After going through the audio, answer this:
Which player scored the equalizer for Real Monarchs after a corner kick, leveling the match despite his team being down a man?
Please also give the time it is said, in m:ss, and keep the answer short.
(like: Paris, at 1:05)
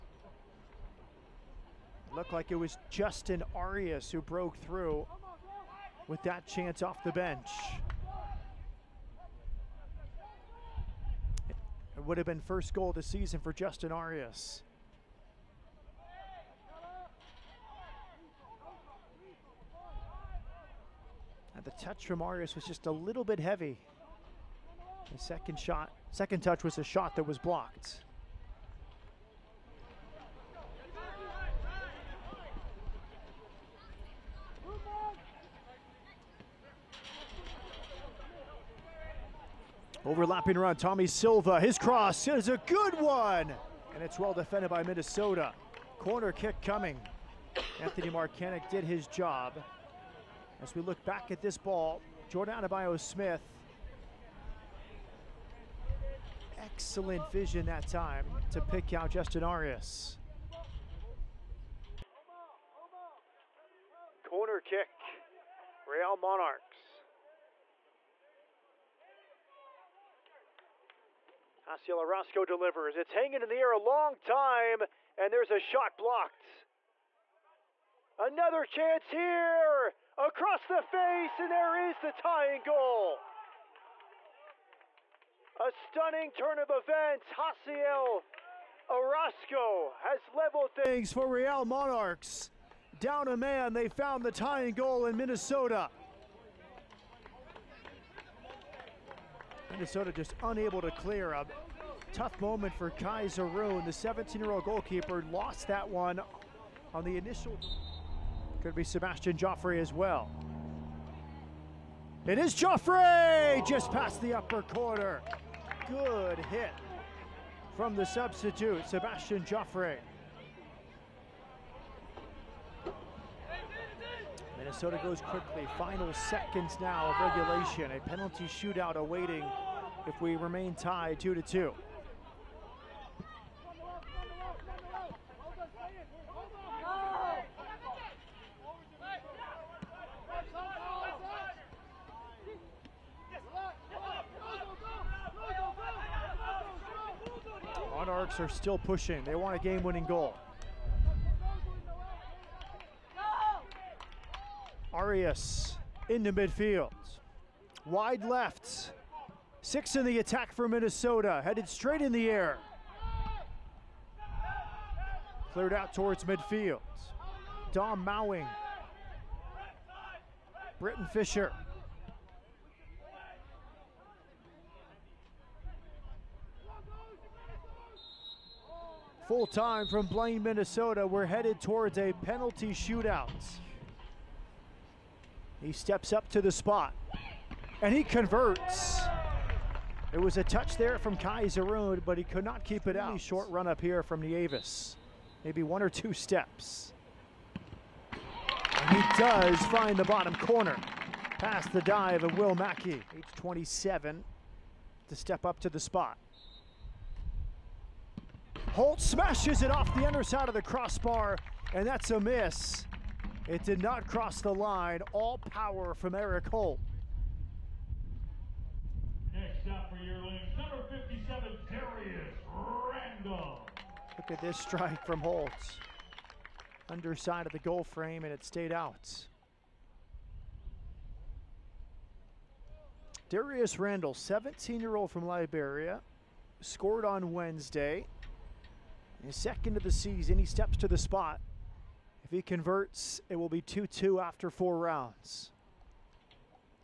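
Haciel Orozco, at 1:27.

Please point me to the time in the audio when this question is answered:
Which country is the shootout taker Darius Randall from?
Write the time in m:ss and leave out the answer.
3:55.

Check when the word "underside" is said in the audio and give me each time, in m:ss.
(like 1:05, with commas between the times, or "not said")
3:30, 3:46.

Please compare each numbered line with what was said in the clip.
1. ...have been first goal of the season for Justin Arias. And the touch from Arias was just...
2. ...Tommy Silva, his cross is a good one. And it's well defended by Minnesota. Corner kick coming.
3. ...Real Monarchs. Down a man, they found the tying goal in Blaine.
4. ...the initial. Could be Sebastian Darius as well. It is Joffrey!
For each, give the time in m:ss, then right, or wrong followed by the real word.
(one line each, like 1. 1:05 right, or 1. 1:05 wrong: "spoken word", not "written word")
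1. 0:12 right
2. 0:40 right
3. 1:31 wrong: "Minnesota", not "Blaine"
4. 1:47 wrong: "Joffrey", not "Darius".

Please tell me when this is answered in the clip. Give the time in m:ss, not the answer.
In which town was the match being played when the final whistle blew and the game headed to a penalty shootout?
3:00.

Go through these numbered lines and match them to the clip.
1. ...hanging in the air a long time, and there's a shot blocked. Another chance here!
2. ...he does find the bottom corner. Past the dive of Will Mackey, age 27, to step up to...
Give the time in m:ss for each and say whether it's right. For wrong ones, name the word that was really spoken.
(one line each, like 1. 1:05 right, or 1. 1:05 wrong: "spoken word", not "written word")
1. 1:13 right
2. 3:18 right.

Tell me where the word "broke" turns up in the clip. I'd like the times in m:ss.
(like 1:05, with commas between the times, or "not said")
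0:04.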